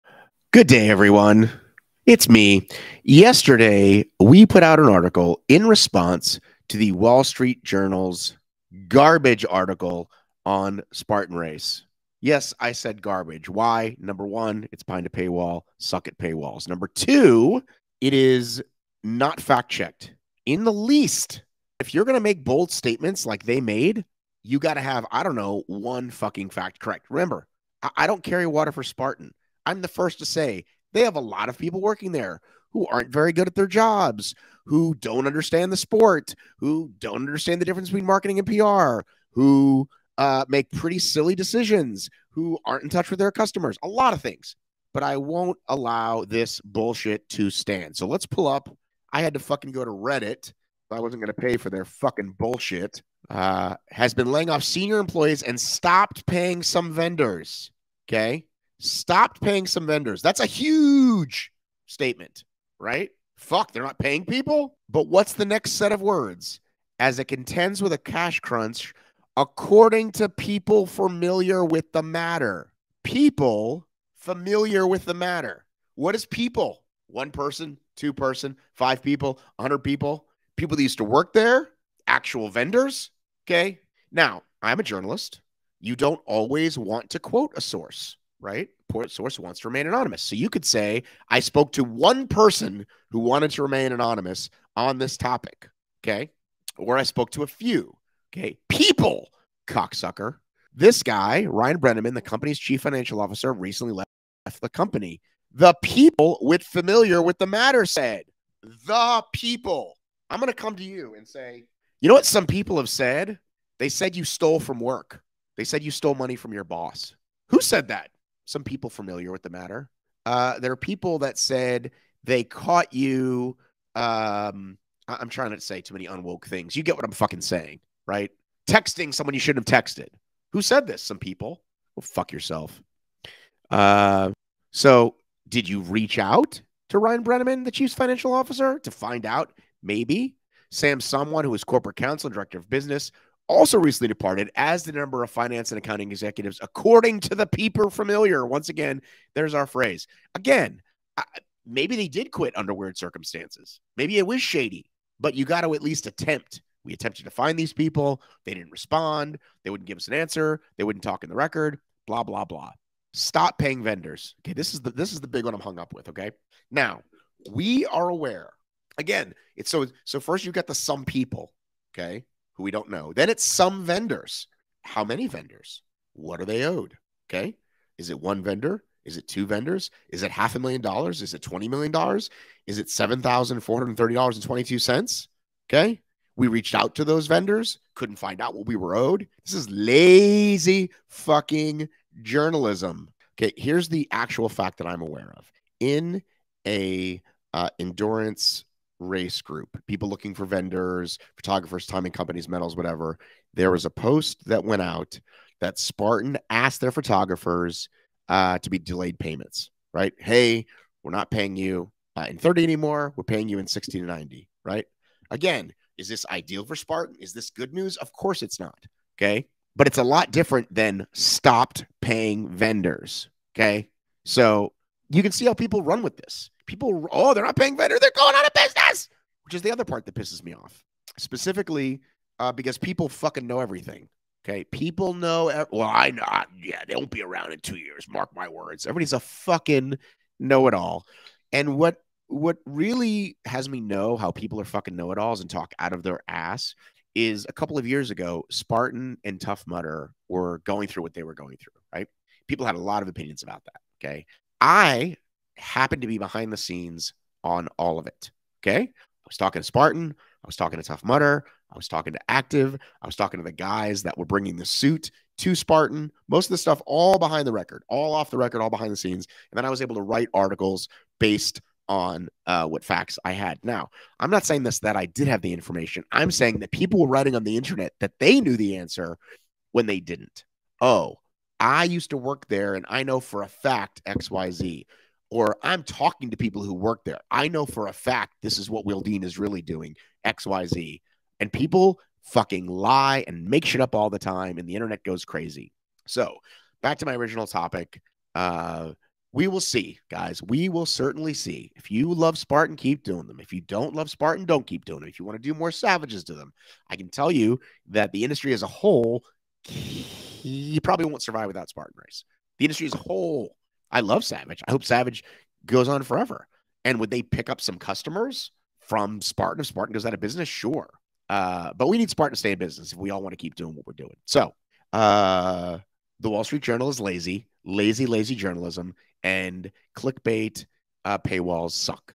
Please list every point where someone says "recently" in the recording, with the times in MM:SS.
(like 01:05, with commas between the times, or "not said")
01:43, 02:23.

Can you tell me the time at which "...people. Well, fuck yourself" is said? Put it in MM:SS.
02:11.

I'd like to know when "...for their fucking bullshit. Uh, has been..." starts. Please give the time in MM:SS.
00:51.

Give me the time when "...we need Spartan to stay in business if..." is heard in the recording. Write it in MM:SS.
05:21.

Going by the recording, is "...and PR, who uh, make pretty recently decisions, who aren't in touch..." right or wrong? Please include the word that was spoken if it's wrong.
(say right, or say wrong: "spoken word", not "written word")
wrong: "silly", not "recently".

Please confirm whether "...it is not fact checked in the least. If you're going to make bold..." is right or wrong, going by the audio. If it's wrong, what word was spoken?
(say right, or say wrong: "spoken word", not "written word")
right.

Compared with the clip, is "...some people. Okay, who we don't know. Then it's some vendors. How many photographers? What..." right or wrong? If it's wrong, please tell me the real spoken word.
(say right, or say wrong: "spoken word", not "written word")
wrong: "vendors", not "photographers".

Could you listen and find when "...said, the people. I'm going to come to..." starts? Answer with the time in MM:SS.
01:47.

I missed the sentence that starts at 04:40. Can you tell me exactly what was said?
Oh, I used to work there and I know for a fact XYZ or I'm talking to people who work there.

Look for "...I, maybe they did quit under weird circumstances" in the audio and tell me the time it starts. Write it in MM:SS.
02:31.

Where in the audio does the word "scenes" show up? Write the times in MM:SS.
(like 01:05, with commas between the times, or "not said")
04:16, 04:28.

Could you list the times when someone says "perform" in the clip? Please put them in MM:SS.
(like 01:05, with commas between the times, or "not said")
not said.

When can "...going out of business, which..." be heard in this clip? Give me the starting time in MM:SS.
03:48.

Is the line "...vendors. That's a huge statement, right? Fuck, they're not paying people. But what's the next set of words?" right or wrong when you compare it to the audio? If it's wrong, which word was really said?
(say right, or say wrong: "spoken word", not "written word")
right.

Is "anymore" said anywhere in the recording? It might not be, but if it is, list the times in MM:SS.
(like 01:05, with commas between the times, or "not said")
03:32.